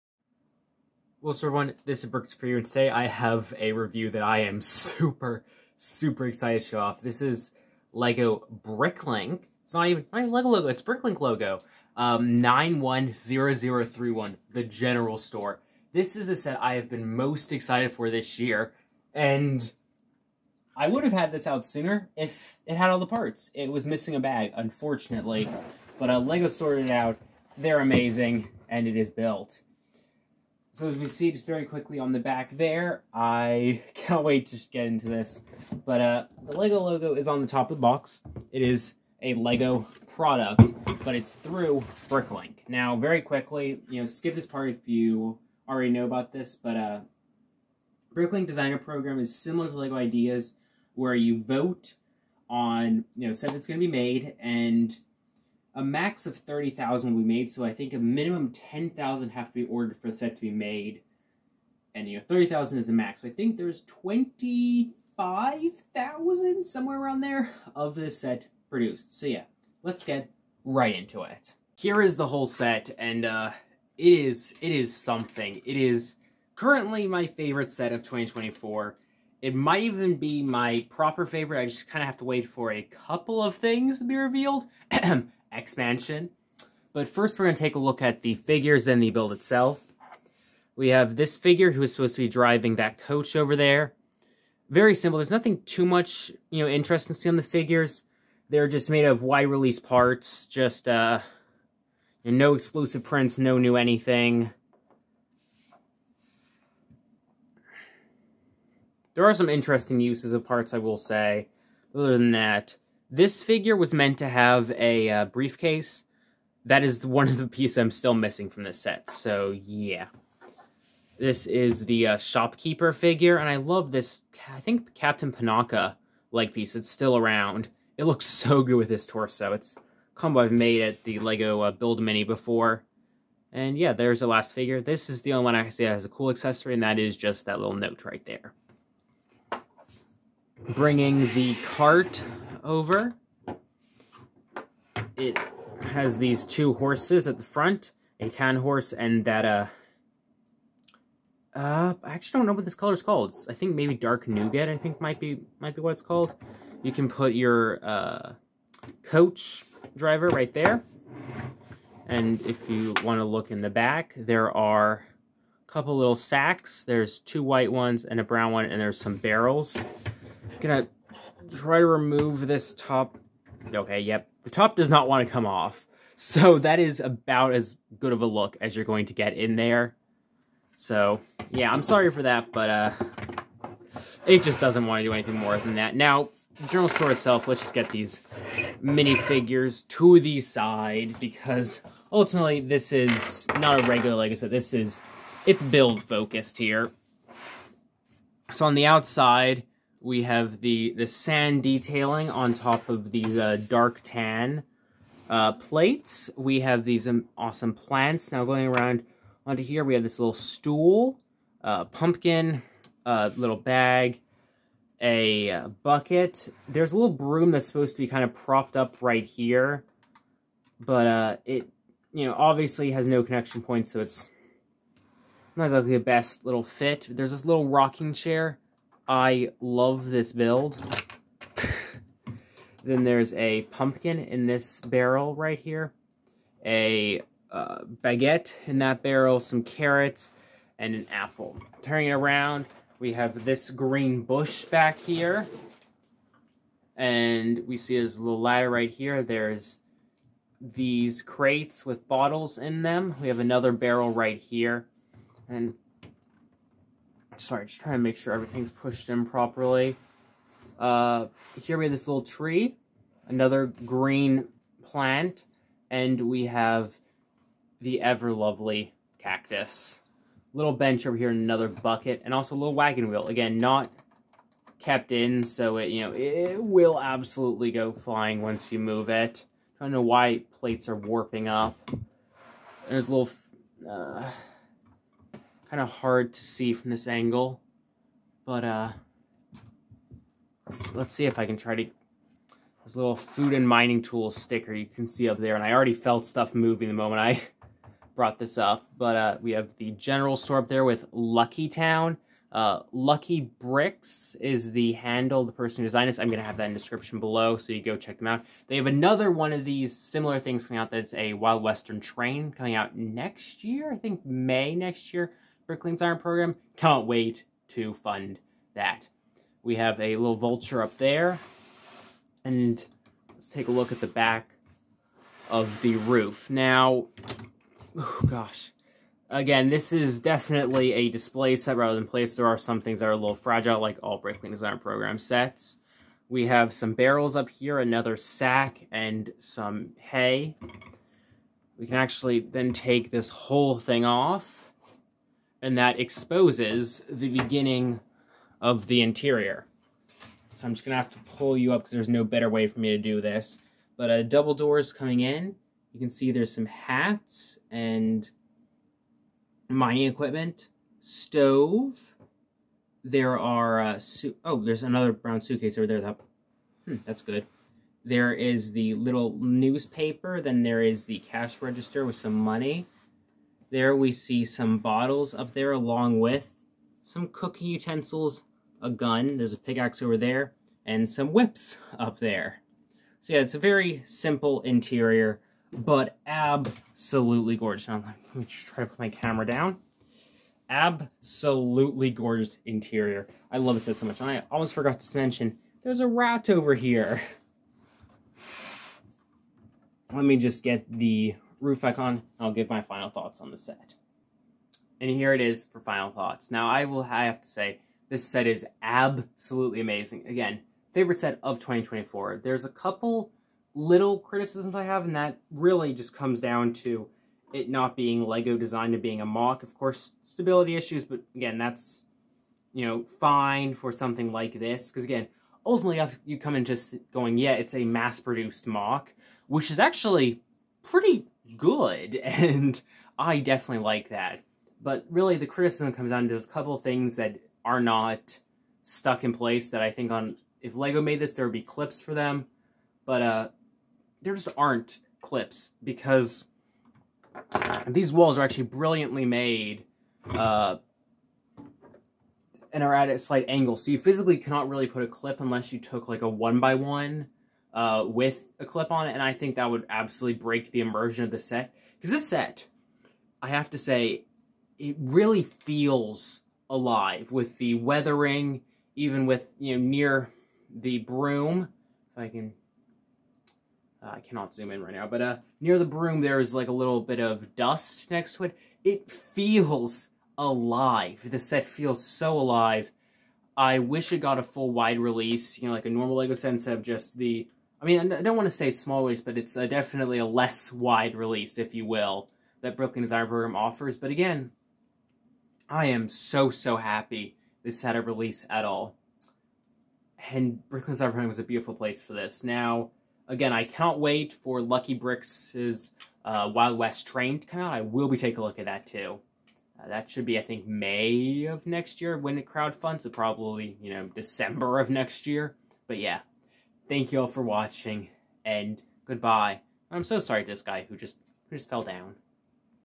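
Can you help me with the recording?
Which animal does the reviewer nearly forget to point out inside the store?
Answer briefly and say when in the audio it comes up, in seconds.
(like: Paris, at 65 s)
rat, at 396 s.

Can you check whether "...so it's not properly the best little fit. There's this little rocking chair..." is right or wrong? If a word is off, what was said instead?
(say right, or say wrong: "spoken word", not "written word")
wrong: "exactly", not "properly".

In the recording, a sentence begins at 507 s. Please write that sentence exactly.
I will be taking a look at that, too.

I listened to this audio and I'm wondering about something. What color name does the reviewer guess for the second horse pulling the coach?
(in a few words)
dark nougat.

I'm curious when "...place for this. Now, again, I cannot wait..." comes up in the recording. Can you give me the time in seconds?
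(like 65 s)
501 s.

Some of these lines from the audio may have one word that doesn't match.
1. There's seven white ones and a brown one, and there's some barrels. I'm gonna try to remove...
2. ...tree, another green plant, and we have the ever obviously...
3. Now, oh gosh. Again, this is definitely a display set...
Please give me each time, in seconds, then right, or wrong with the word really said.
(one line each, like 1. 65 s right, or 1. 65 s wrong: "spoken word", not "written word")
1. 166 s wrong: "two", not "seven"
2. 262 s wrong: "lovely", not "obviously"
3. 326 s right.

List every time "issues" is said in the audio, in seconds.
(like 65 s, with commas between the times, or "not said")
420 s.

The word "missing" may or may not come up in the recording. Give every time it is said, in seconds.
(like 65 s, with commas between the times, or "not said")
23 s, 118 s.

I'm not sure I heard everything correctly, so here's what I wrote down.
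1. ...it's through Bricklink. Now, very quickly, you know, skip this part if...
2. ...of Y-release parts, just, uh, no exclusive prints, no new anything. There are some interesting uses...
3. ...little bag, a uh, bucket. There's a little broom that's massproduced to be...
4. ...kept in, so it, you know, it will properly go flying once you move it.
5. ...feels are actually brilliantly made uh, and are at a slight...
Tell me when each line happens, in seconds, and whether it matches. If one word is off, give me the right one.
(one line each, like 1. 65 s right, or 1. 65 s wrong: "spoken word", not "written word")
1. 41 s right
2. 99 s right
3. 213 s wrong: "supposed", not "massproduced"
4. 274 s wrong: "absolutely", not "properly"
5. 448 s wrong: "walls", not "feels".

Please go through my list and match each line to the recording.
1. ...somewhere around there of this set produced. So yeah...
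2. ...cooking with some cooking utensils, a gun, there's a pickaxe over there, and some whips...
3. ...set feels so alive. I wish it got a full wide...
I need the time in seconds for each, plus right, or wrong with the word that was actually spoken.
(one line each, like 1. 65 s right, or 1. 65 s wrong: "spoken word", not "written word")
1. 66 s right
2. 375 s wrong: "along", not "cooking"
3. 481 s right.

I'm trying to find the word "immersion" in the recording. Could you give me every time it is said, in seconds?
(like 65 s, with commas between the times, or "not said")
460 s.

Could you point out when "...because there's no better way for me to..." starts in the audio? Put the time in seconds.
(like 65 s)
351 s.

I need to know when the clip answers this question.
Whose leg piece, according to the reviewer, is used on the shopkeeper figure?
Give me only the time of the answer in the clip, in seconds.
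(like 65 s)
124 s.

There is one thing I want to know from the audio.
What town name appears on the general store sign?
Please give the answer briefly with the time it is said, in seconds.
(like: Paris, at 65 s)
Lucky Town, at 301 s.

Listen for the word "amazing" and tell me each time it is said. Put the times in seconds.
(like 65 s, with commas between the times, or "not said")
27 s, 409 s.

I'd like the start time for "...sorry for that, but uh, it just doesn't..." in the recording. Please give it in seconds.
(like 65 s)
181 s.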